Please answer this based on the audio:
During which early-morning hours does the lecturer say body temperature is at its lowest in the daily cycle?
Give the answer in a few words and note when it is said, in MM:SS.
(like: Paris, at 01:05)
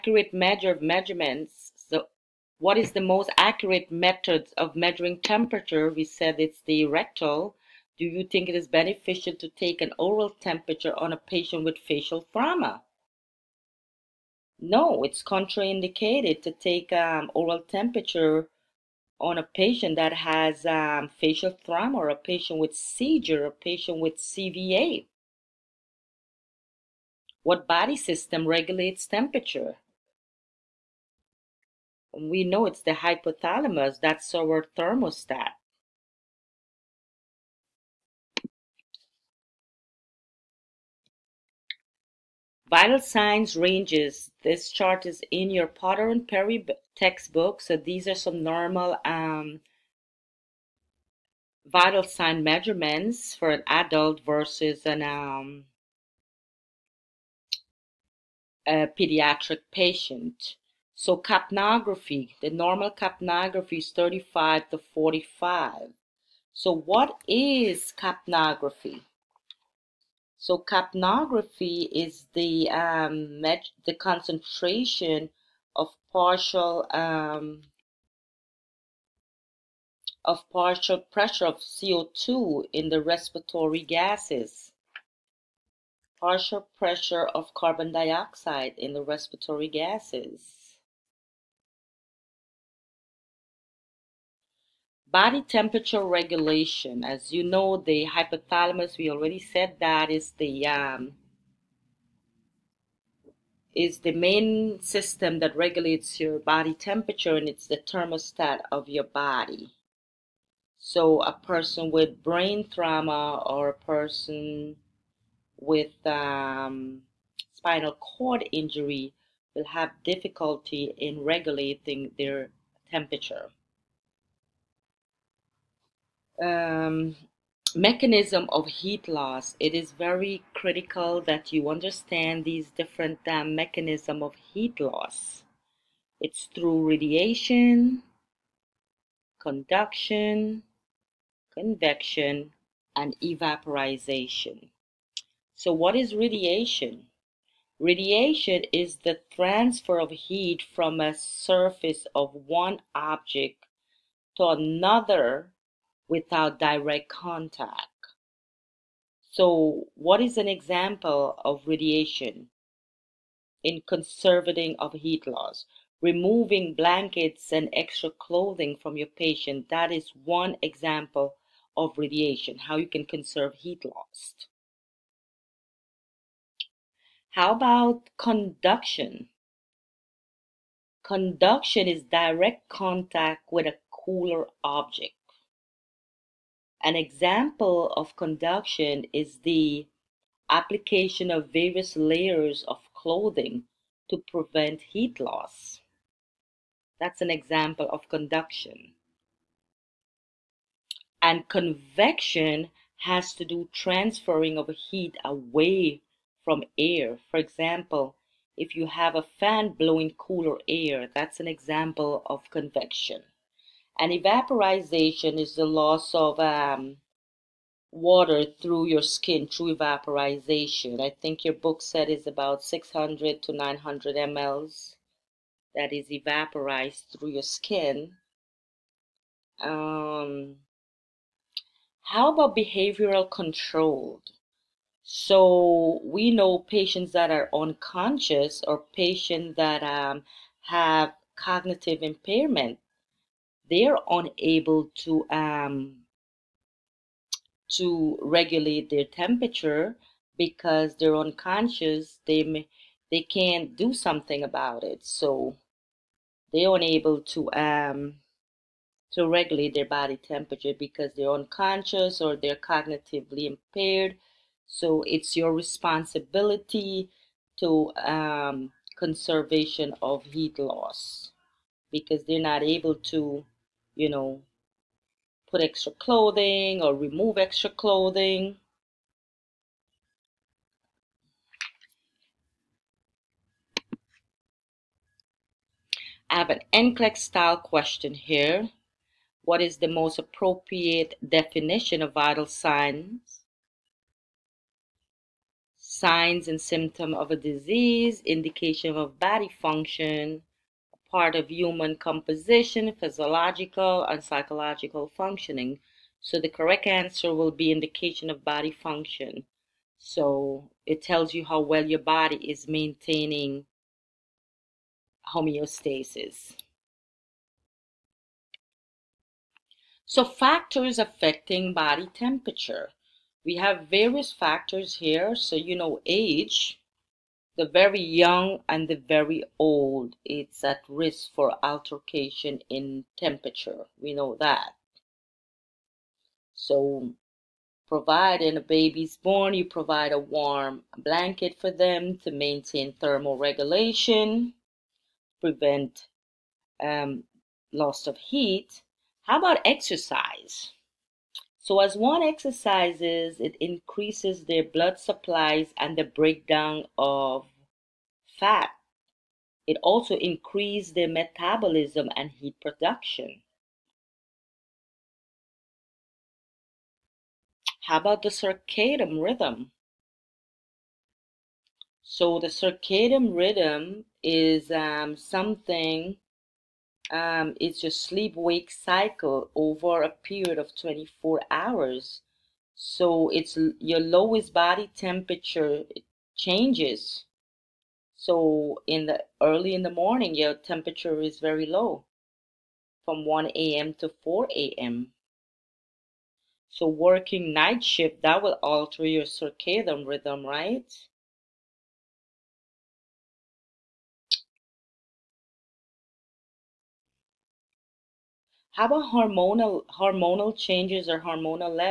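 1 a.m. to 4 a.m., at 06:33.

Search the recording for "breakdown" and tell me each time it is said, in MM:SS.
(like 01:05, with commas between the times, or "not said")
05:56.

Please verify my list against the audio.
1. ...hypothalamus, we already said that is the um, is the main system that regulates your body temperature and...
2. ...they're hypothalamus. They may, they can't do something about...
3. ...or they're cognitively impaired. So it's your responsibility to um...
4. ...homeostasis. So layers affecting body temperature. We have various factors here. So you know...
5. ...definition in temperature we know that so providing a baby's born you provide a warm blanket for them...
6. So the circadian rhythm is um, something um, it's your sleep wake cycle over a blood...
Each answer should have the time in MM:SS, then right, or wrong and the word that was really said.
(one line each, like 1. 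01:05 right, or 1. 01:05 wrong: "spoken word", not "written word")
1. 01:38 right
2. 04:10 wrong: "unconscious", not "hypothalamus"
3. 04:22 right
4. 05:15 wrong: "factors", not "layers"
5. 05:31 wrong: "altercation", not "definition"
6. 06:12 wrong: "period", not "blood".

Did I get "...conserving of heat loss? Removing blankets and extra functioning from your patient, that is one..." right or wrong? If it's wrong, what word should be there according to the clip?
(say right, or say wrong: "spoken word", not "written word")
wrong: "clothing", not "functioning".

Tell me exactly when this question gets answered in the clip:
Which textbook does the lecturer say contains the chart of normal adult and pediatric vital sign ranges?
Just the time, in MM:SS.
00:45.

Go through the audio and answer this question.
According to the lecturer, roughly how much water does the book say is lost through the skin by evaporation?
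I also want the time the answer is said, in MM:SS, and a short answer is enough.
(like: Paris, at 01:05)
600 to 900 mL, at 03:42.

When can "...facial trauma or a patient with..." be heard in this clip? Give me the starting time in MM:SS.
00:21.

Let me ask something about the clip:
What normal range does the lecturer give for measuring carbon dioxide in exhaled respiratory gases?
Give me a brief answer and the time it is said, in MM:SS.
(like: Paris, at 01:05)
35 to 45, at 01:03.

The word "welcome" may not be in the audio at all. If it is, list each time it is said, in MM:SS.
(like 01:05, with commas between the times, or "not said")
not said.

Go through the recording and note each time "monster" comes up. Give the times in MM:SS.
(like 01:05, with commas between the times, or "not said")
not said.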